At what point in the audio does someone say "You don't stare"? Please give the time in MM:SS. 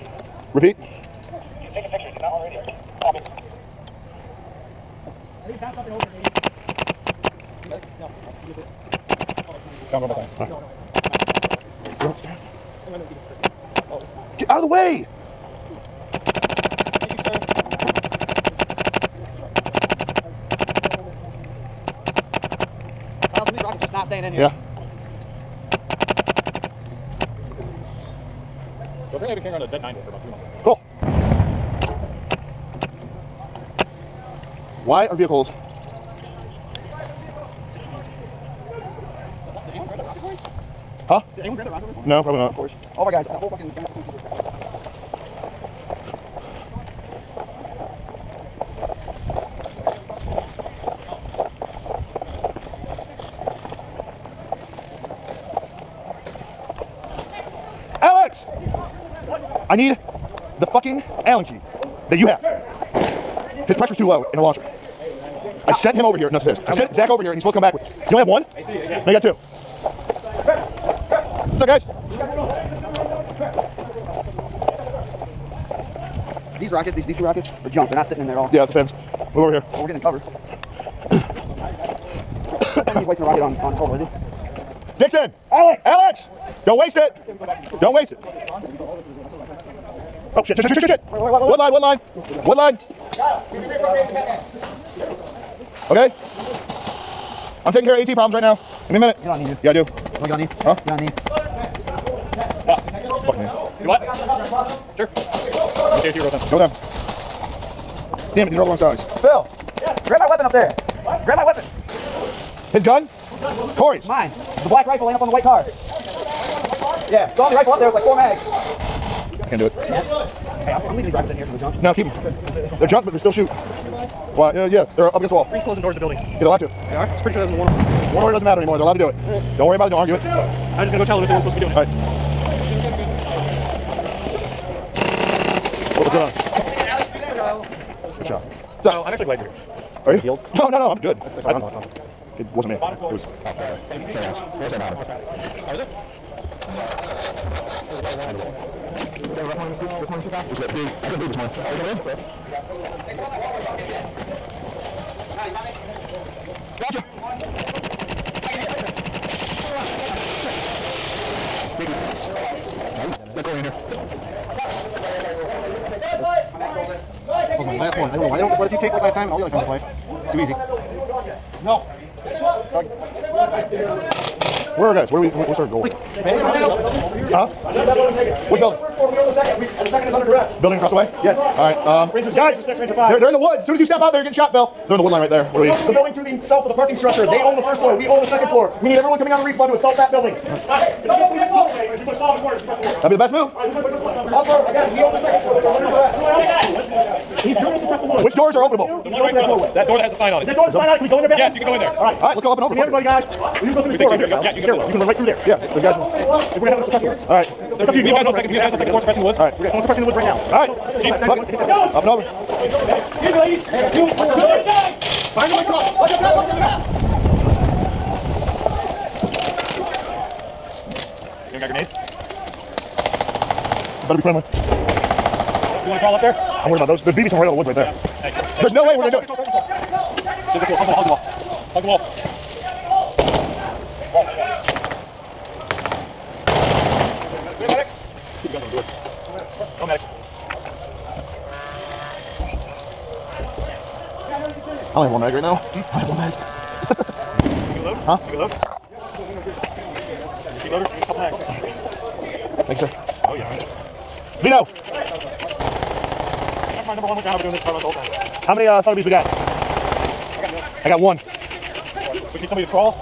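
00:12.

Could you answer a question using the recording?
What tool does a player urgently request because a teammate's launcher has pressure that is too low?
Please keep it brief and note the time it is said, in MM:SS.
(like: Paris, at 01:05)
Allen key, at 01:01.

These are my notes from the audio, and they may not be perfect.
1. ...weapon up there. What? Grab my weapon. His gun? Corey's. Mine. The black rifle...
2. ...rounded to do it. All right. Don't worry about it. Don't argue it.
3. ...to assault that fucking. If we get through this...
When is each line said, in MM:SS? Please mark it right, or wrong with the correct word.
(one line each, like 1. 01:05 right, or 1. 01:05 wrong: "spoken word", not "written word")
1. 01:50 right
2. 02:08 wrong: "allowed", not "rounded"
3. 03:09 wrong: "building", not "fucking".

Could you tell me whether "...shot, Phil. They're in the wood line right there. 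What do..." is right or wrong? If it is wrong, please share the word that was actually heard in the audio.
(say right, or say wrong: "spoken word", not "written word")
right.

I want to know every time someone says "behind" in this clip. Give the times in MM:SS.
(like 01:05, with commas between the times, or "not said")
02:24, 03:35.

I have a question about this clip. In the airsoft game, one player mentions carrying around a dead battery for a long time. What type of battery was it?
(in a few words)
9 volt.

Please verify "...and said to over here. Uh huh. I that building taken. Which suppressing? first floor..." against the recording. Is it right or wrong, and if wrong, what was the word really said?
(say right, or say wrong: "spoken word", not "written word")
wrong: "building", not "suppressing".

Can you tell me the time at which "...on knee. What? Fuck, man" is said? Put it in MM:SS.
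01:40.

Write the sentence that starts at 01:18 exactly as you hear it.
Yeah, it's a Move over here.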